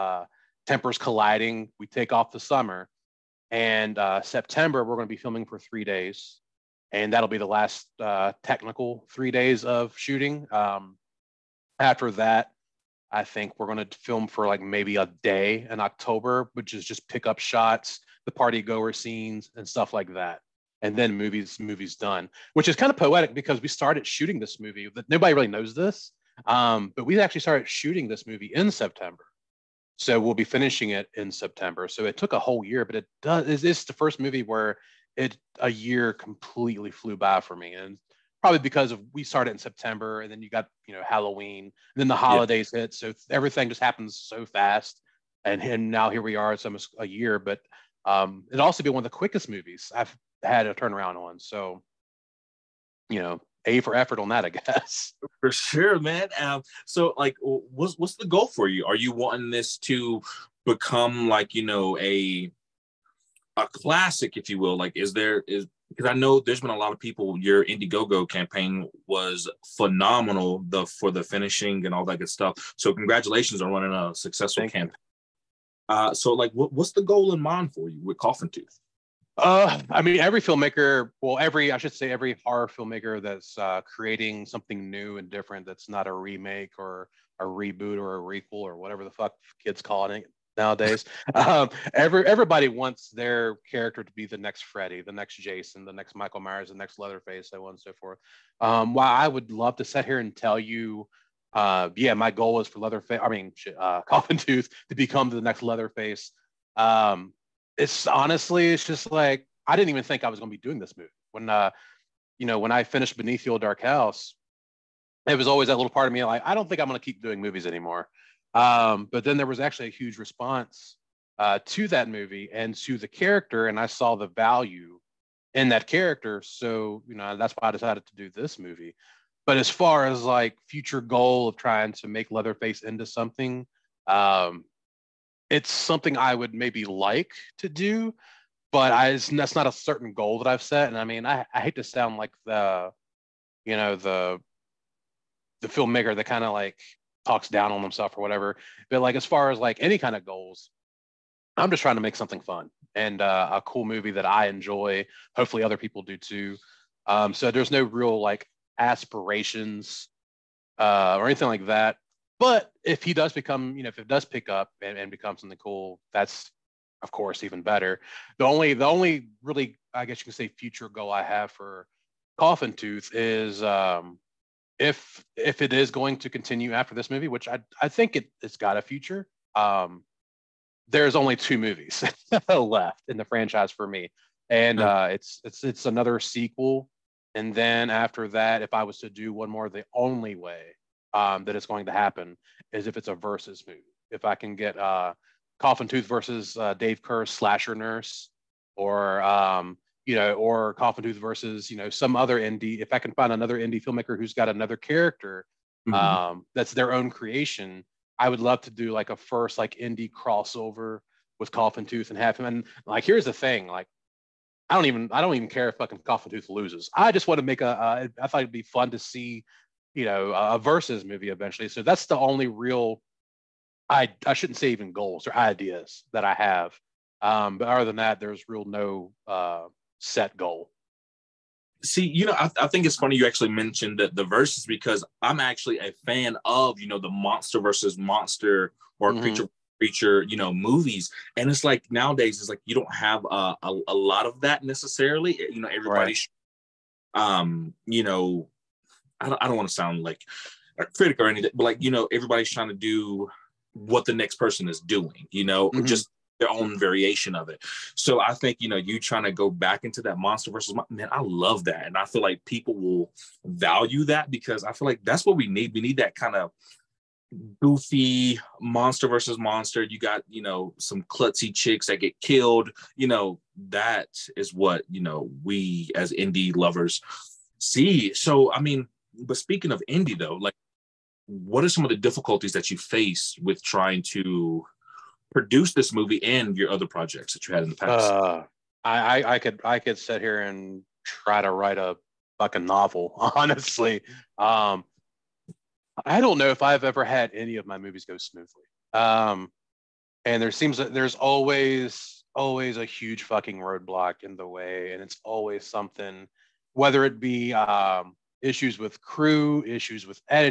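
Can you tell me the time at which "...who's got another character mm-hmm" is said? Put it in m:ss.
3:24.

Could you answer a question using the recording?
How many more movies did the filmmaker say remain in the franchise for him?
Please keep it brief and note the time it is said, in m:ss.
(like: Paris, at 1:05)
2, at 3:01.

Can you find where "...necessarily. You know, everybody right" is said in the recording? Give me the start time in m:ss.
4:04.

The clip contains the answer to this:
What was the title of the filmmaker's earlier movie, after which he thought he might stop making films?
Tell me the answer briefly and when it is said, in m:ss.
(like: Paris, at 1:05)
Beneath the Old Dark House, at 1:53.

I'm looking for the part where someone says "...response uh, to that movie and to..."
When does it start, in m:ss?
2:00.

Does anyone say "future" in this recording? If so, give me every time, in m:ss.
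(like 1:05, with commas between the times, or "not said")
2:10, 2:50, 2:58.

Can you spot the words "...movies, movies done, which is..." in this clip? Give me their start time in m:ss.
0:21.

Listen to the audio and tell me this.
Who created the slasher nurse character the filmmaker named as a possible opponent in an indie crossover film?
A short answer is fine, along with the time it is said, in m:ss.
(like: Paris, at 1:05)
Dave Kerr, at 3:16.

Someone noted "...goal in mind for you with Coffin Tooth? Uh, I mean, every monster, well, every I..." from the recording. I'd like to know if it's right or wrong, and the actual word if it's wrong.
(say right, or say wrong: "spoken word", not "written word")
wrong: "filmmaker", not "monster".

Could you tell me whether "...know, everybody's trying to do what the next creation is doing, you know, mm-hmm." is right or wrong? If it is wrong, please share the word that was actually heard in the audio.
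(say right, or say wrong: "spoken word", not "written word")
wrong: "person", not "creation".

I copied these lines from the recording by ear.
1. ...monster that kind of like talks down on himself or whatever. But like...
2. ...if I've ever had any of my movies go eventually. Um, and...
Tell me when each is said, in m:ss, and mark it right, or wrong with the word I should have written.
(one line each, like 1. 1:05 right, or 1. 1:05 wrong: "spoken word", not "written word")
1. 2:25 wrong: "filmmaker", not "monster"
2. 4:56 wrong: "smoothly", not "eventually".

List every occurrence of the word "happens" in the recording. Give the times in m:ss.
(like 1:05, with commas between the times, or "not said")
0:43, 3:11.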